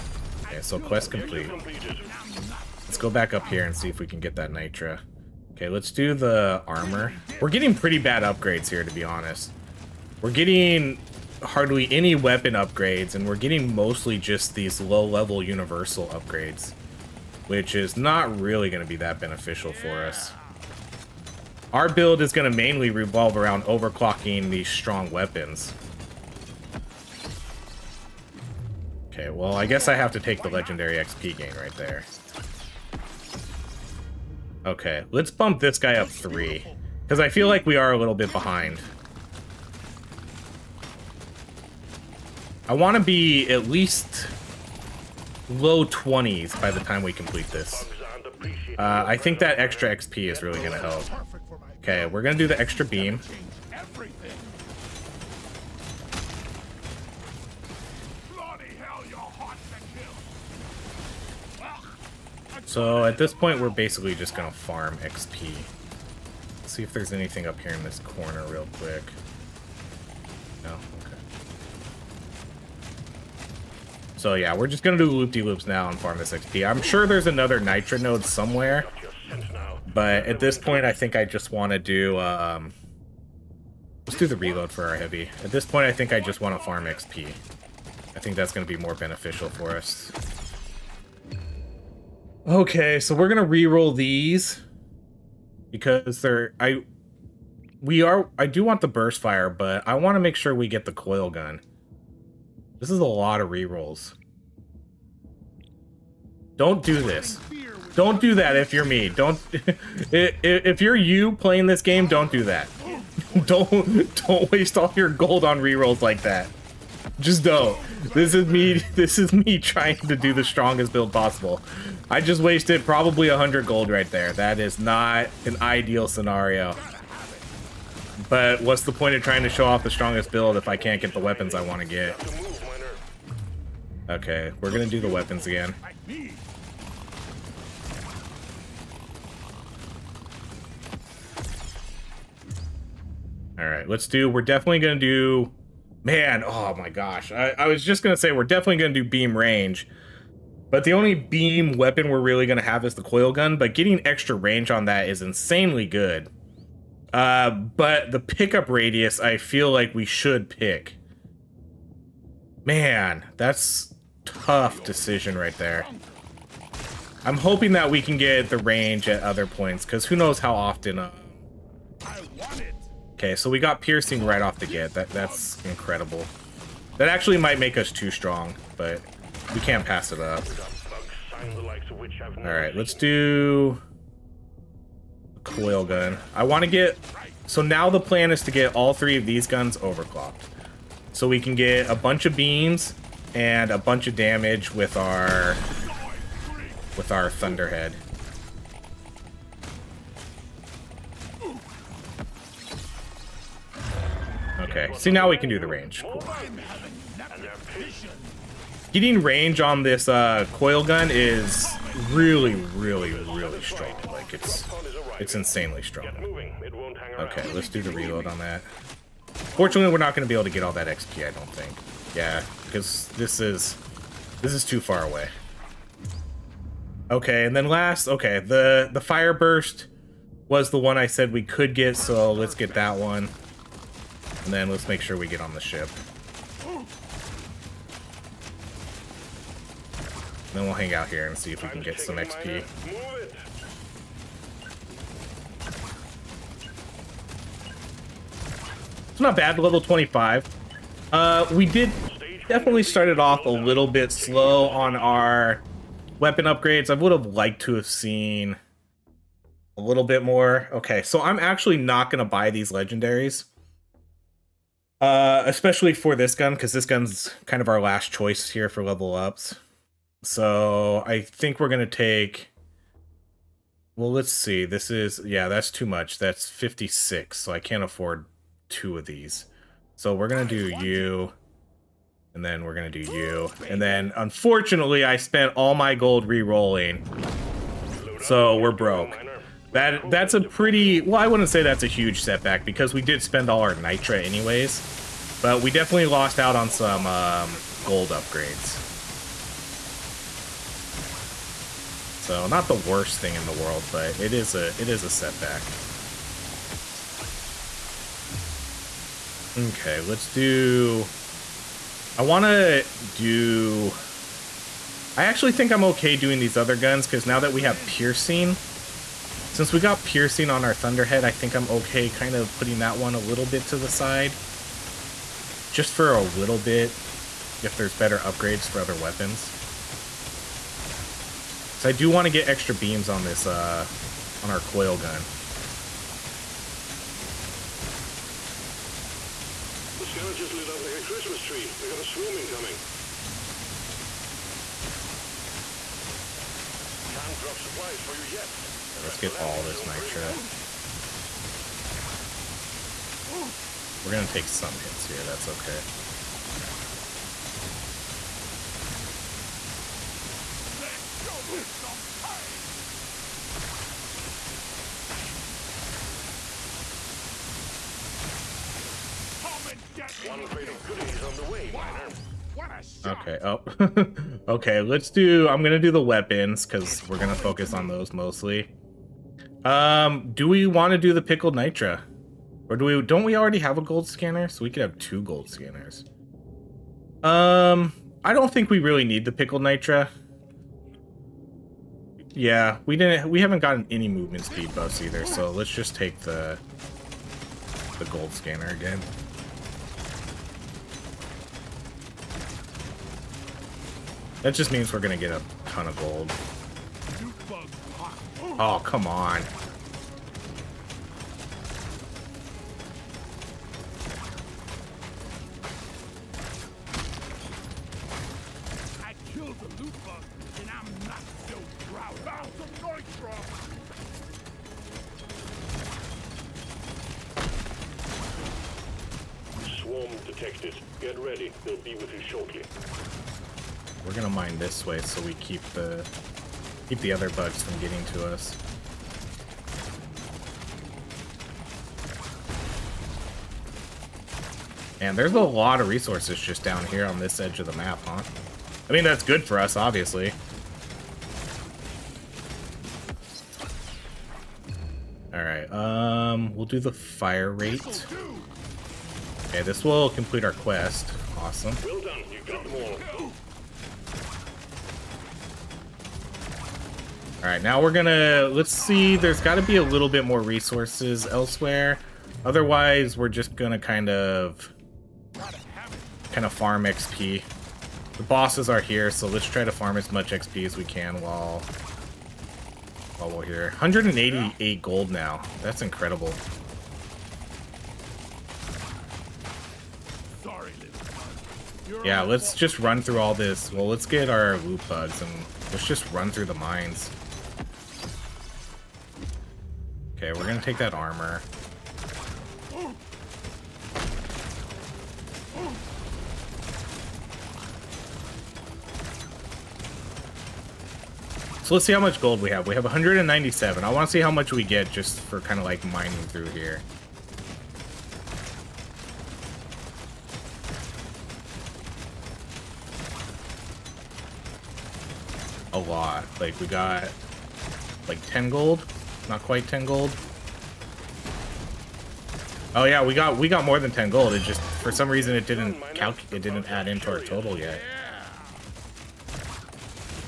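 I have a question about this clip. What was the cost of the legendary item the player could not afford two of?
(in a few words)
56.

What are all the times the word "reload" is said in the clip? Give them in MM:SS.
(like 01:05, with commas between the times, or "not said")
01:24, 03:37.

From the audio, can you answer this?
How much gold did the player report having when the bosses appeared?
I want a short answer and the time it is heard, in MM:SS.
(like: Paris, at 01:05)
188, at 08:03.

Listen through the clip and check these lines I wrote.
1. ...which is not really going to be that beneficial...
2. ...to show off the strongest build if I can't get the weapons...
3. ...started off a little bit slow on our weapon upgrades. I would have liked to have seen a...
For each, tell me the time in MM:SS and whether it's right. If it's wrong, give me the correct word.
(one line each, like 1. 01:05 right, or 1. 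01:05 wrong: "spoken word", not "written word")
1. 00:17 right
2. 02:09 right
3. 04:12 right.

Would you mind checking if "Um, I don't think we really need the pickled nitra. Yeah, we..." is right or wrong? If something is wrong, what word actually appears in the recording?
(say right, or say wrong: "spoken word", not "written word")
right.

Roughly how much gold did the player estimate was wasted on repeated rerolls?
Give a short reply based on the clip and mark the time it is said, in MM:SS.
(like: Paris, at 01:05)
100, at 02:03.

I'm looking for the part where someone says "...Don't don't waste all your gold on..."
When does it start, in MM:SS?
01:53.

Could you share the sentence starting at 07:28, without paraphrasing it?
I mean, that's good for us, obviously.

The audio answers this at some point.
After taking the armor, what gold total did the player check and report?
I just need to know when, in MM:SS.
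08:32.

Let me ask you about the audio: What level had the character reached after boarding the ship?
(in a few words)
25.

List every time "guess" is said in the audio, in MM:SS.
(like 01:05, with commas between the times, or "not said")
00:29.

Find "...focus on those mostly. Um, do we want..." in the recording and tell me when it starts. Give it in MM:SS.
06:17.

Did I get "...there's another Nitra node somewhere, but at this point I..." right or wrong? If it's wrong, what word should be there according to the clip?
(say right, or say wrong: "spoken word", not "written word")
right.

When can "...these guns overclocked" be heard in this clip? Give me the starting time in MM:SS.
03:09.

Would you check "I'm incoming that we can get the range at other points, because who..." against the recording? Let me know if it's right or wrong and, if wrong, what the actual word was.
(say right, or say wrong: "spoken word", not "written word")
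wrong: "hoping", not "incoming".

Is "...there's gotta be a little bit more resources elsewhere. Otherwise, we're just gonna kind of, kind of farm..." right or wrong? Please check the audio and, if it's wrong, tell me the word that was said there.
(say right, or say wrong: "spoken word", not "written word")
right.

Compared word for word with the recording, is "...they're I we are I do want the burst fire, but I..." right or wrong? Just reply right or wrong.
right.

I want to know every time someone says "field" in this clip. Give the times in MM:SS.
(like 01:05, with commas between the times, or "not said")
not said.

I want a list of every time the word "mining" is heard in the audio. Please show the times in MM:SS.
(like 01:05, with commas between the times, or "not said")
08:35.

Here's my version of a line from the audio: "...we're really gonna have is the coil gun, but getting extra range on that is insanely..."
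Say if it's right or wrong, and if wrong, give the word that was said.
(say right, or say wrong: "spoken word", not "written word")
right.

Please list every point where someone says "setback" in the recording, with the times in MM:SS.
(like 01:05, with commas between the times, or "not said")
04:52, 05:05.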